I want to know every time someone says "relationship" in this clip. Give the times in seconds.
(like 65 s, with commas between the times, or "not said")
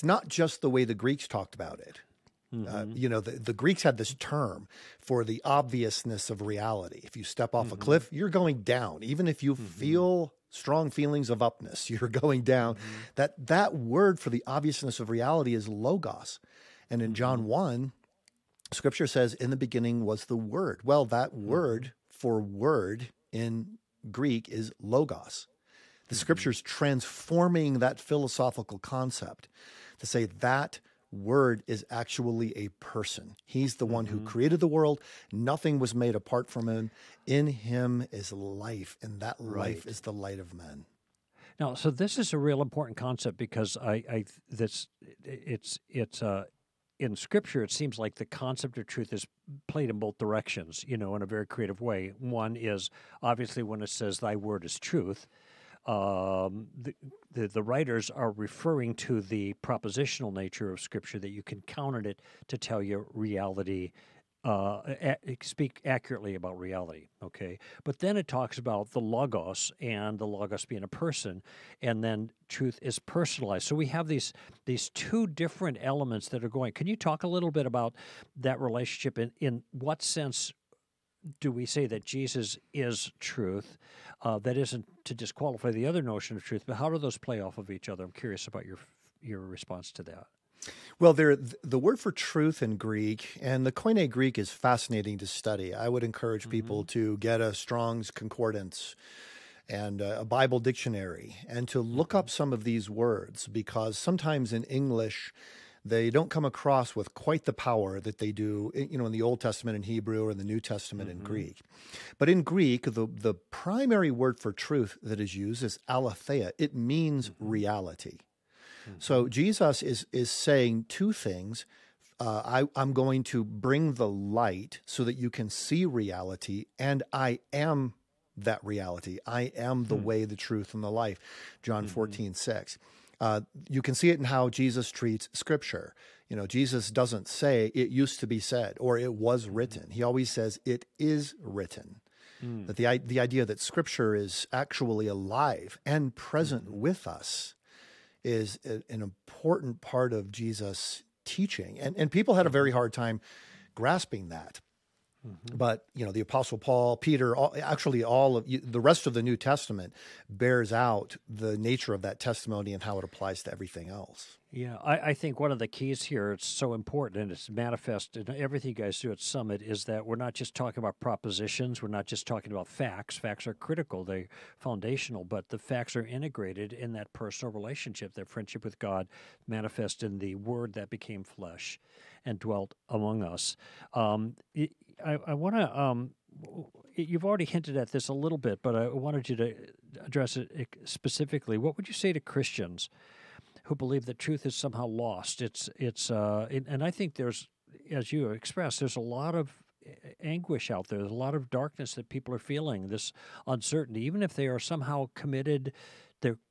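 78 s, 177 s.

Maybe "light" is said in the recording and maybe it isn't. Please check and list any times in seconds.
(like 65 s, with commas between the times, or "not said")
40 s, 124 s.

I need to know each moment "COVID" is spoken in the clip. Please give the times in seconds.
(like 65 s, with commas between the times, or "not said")
not said.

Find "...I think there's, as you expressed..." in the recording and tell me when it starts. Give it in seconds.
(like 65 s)
196 s.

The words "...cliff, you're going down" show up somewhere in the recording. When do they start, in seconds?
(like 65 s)
7 s.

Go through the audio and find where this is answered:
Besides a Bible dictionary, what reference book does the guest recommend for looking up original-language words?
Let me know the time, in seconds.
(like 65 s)
97 s.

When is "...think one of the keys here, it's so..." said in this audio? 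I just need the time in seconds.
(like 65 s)
165 s.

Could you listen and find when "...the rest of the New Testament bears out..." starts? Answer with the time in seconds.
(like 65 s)
158 s.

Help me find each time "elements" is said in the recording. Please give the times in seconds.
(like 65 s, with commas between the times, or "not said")
75 s.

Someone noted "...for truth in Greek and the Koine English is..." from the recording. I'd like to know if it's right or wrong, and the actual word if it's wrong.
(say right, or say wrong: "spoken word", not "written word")
wrong: "Greek", not "English".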